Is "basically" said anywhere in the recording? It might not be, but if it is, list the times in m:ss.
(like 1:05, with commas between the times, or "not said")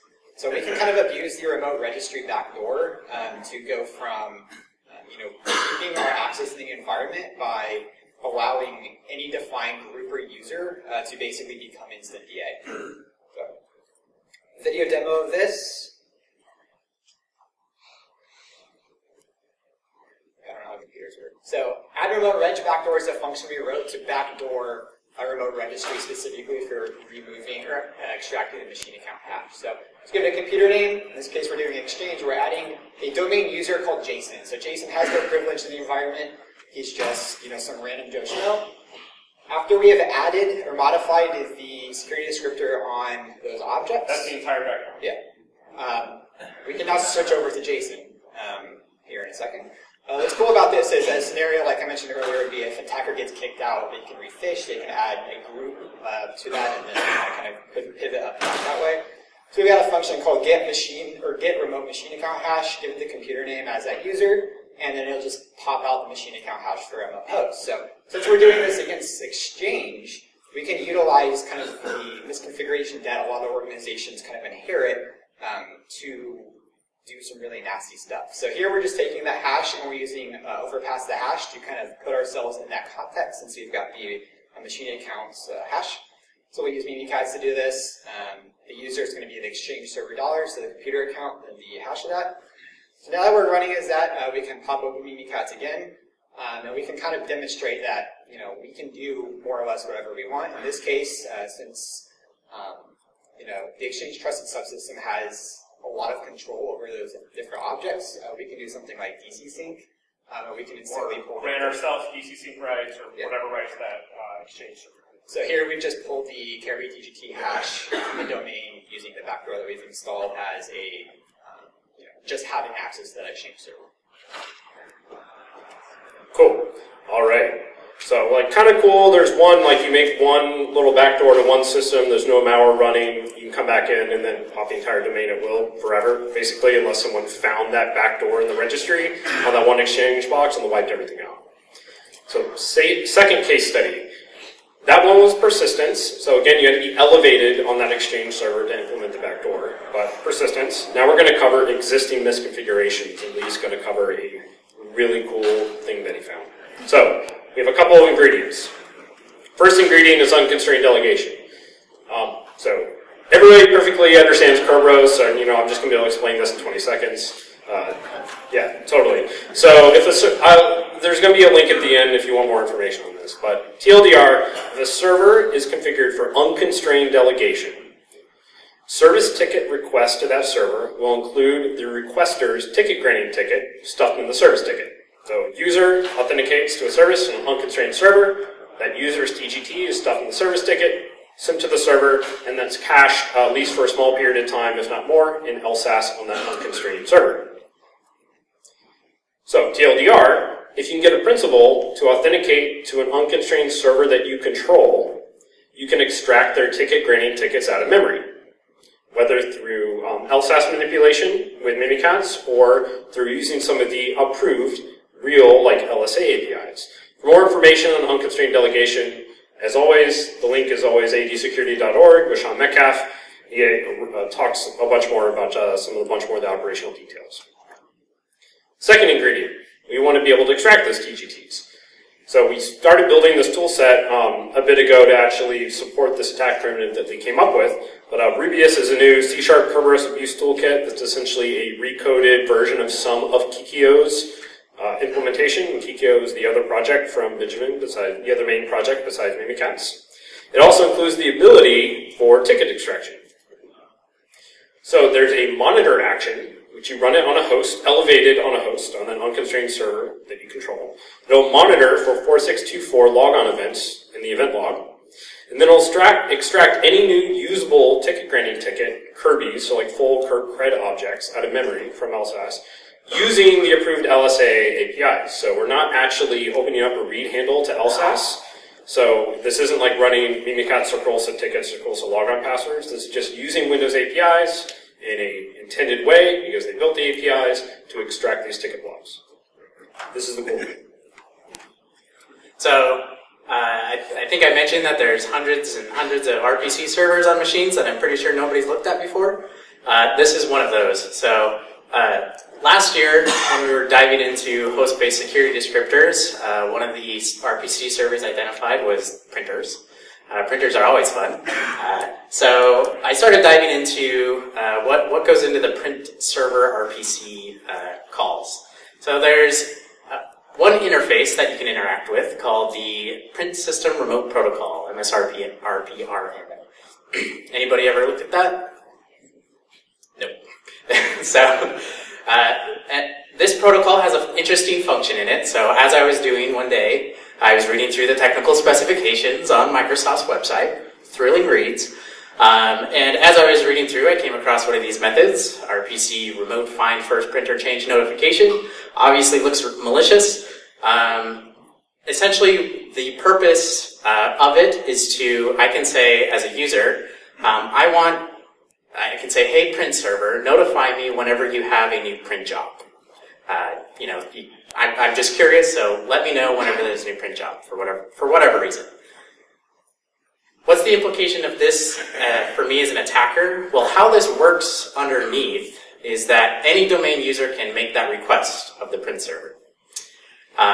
0:11, 2:16.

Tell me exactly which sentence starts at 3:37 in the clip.
For more information on unconstrained delegation, as always, the link is always adsecurity.org with Sean Metcalf.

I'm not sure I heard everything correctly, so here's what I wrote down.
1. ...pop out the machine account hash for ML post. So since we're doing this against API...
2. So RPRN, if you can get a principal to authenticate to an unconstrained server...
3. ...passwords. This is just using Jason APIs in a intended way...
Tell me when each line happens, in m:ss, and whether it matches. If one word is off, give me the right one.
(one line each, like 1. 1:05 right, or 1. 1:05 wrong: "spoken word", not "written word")
1. 1:05 wrong: "Exchange", not "API"
2. 3:19 wrong: "TLDR", not "RPRN"
3. 4:42 wrong: "Windows", not "Jason".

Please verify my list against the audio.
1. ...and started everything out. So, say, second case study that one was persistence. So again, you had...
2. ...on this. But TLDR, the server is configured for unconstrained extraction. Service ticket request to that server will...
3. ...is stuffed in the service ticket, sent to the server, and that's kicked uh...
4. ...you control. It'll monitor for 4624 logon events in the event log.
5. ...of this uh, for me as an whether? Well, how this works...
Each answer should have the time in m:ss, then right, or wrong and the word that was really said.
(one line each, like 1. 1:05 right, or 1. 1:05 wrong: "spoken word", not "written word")
1. 2:20 wrong: "wiped", not "started"
2. 2:53 wrong: "delegation", not "extraction"
3. 3:09 wrong: "cached", not "kicked"
4. 4:20 right
5. 6:11 wrong: "attacker", not "whether".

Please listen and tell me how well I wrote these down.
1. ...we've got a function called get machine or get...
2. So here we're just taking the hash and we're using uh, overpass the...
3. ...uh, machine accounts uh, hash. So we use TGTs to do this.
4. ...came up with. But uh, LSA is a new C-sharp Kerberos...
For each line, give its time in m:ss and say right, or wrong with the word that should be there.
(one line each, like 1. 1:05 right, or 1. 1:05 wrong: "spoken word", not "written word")
1. 0:59 right
2. 1:18 right
3. 1:24 wrong: "Mimikatz", not "TGTs"
4. 3:57 wrong: "Rubius", not "LSA".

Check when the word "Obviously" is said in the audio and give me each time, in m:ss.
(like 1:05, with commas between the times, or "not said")
5:48.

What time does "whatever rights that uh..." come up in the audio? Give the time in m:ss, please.
1:53.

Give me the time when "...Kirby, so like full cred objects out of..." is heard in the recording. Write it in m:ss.
4:29.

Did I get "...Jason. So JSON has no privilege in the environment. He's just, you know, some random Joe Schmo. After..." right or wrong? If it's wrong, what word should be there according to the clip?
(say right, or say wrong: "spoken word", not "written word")
wrong: "Jason", not "JSON".